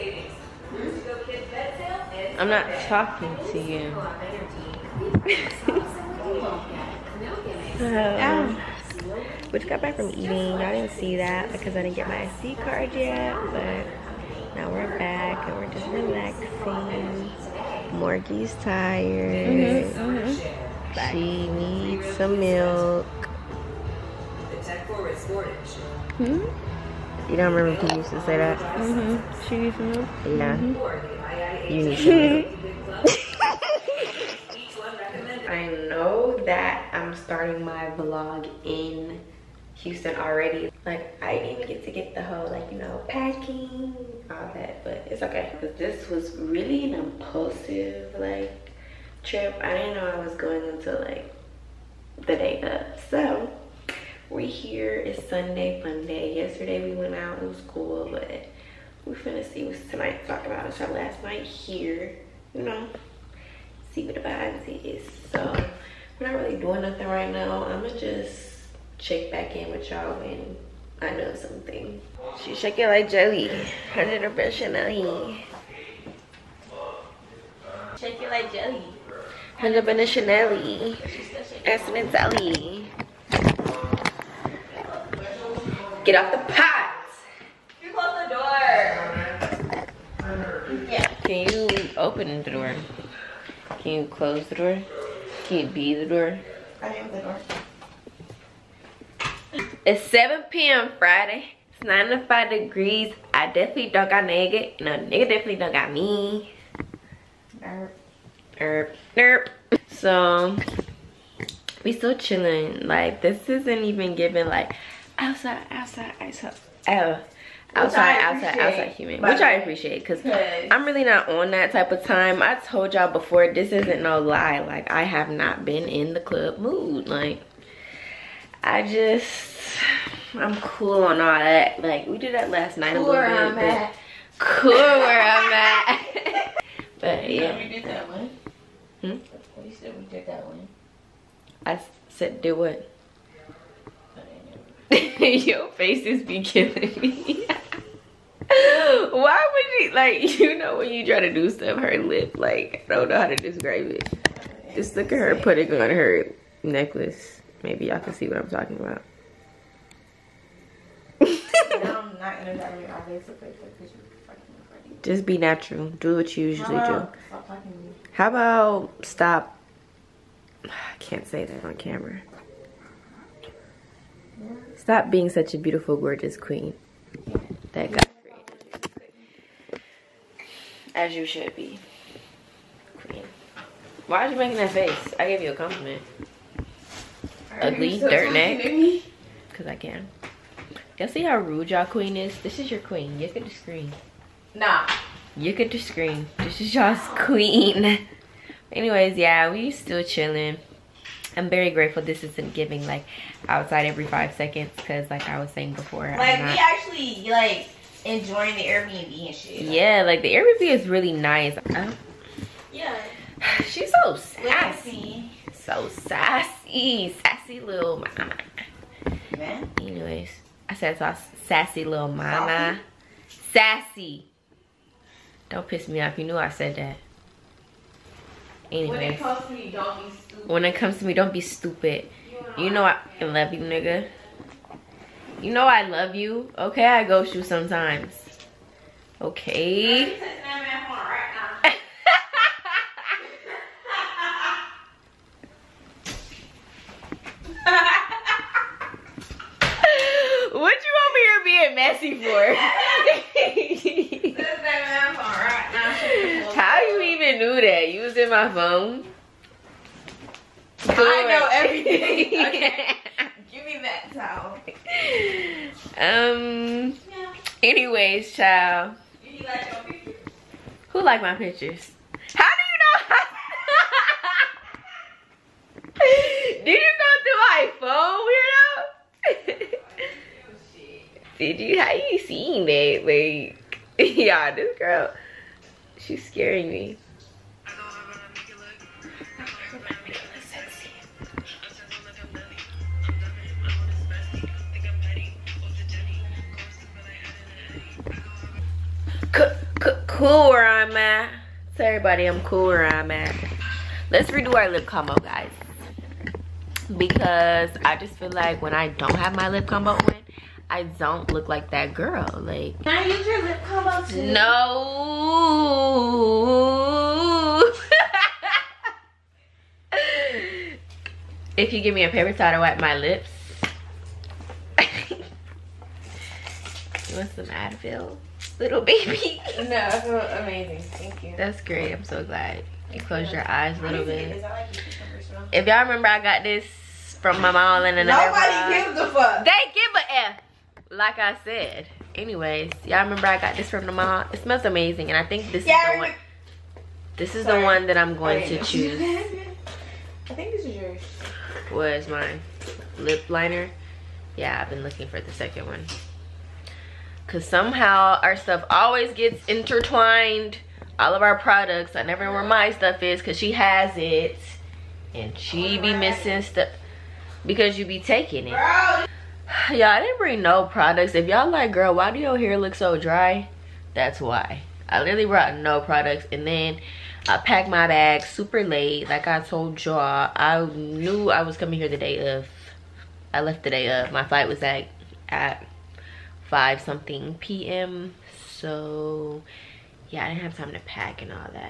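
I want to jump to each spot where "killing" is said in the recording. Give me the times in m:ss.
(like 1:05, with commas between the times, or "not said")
2:26.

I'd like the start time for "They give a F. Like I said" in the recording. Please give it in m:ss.
5:39.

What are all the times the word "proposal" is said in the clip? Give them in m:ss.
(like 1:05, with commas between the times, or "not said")
not said.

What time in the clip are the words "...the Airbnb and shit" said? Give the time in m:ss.
3:28.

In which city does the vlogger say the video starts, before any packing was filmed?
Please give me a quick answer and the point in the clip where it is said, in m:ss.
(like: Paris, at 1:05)
Houston, at 0:39.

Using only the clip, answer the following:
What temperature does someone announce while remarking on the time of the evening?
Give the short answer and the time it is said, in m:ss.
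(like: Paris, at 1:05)
95 degrees, at 1:41.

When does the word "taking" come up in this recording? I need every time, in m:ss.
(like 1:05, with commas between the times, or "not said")
6:07.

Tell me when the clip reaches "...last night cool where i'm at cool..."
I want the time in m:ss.
2:12.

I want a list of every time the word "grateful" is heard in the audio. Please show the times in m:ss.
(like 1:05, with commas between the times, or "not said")
3:21.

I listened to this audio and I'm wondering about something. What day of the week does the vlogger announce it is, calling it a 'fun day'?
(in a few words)
Sunday.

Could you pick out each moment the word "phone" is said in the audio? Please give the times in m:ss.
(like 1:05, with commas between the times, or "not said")
4:18, 4:37.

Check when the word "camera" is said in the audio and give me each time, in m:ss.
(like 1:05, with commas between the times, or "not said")
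2:51.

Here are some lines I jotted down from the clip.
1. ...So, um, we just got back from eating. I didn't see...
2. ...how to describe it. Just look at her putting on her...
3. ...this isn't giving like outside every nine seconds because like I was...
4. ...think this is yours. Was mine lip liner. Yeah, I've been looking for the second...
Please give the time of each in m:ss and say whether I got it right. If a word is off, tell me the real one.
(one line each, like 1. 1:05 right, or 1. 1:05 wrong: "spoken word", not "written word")
1. 0:07 right
2. 2:33 right
3. 3:22 wrong: "five", not "nine"
4. 5:50 right.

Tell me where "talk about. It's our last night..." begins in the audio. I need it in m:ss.
1:00.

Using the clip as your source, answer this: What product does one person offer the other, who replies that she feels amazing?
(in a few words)
Advil.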